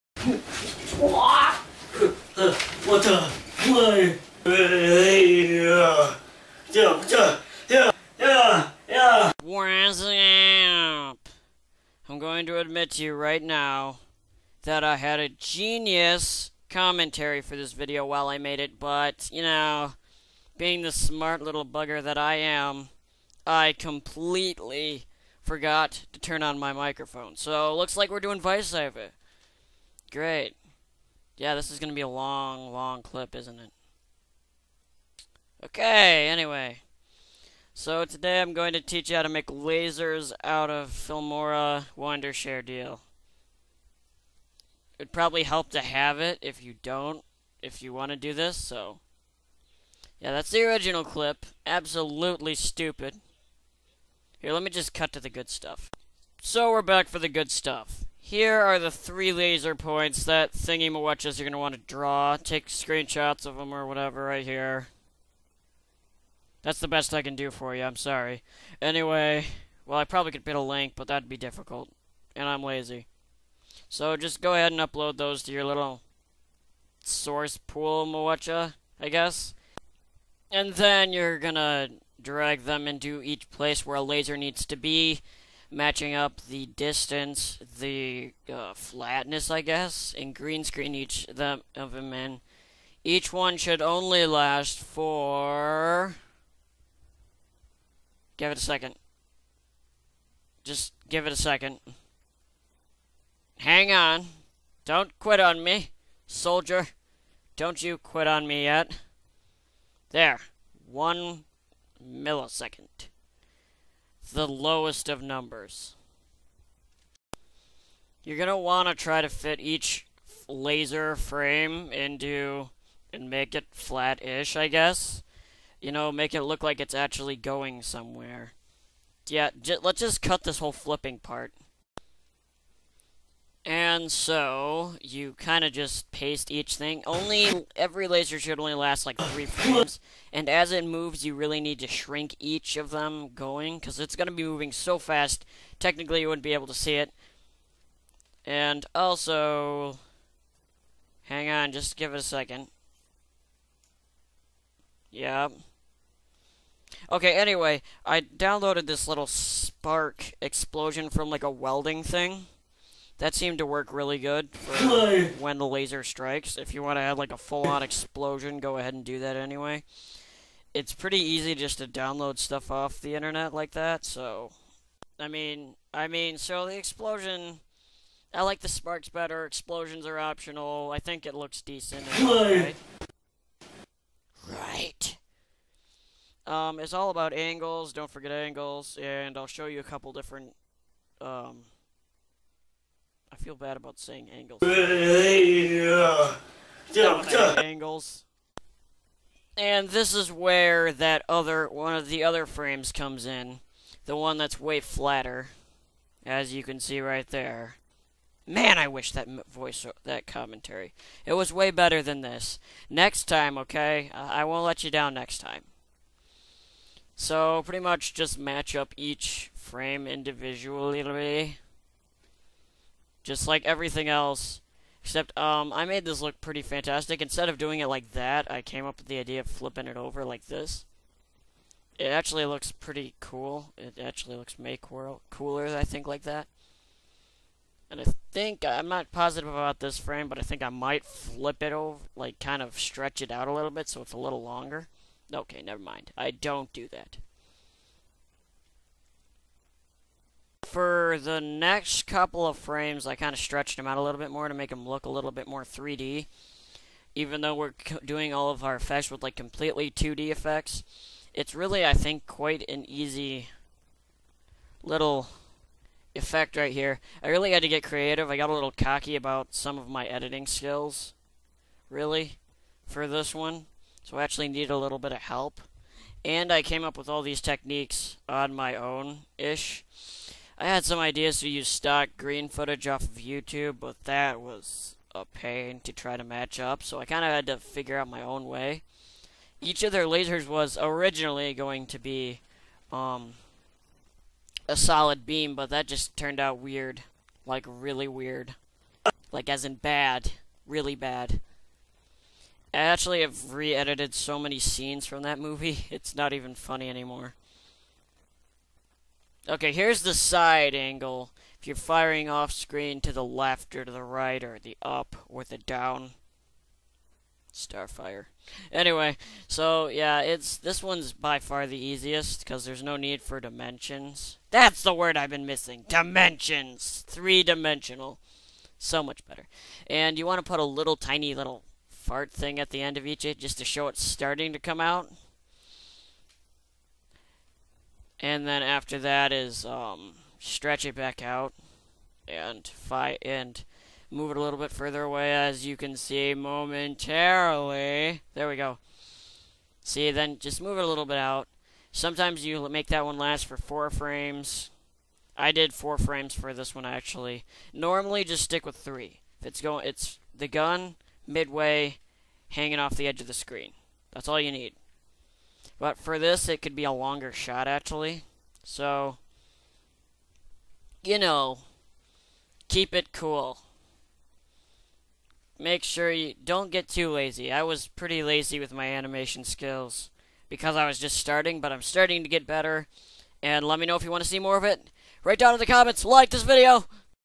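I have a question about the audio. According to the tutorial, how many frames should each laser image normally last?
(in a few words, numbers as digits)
3.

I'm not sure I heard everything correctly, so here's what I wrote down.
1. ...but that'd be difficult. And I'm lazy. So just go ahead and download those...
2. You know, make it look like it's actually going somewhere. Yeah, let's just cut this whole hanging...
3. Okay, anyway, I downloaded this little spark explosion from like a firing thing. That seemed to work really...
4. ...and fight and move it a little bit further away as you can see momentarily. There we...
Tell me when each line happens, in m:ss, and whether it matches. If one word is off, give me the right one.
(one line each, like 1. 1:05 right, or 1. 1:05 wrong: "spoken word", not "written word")
1. 1:10 wrong: "upload", not "download"
2. 2:05 wrong: "flipping", not "hanging"
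3. 2:37 wrong: "welding", not "firing"
4. 5:42 right.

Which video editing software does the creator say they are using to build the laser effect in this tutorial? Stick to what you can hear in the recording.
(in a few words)
Filmora Wondershare.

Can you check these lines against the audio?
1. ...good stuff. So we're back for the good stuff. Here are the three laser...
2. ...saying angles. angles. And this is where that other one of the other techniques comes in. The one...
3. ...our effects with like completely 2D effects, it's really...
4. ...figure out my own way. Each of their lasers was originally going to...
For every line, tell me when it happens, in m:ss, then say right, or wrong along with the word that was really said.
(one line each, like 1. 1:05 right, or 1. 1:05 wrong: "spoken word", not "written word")
1. 0:55 right
2. 3:13 wrong: "frames", not "techniques"
3. 4:18 right
4. 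4:47 right.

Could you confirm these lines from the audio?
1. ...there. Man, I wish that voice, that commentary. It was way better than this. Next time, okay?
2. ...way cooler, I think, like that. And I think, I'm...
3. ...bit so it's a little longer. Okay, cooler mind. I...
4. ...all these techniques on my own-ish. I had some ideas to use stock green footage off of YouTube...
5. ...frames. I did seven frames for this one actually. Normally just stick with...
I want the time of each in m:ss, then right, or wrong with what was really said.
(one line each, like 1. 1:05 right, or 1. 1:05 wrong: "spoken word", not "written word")
1. 3:27 right
2. 3:54 right
3. 4:03 wrong: "never", not "cooler"
4. 4:37 right
5. 5:53 wrong: "four", not "seven".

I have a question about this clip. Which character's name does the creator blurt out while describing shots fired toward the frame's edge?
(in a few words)
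Starfire.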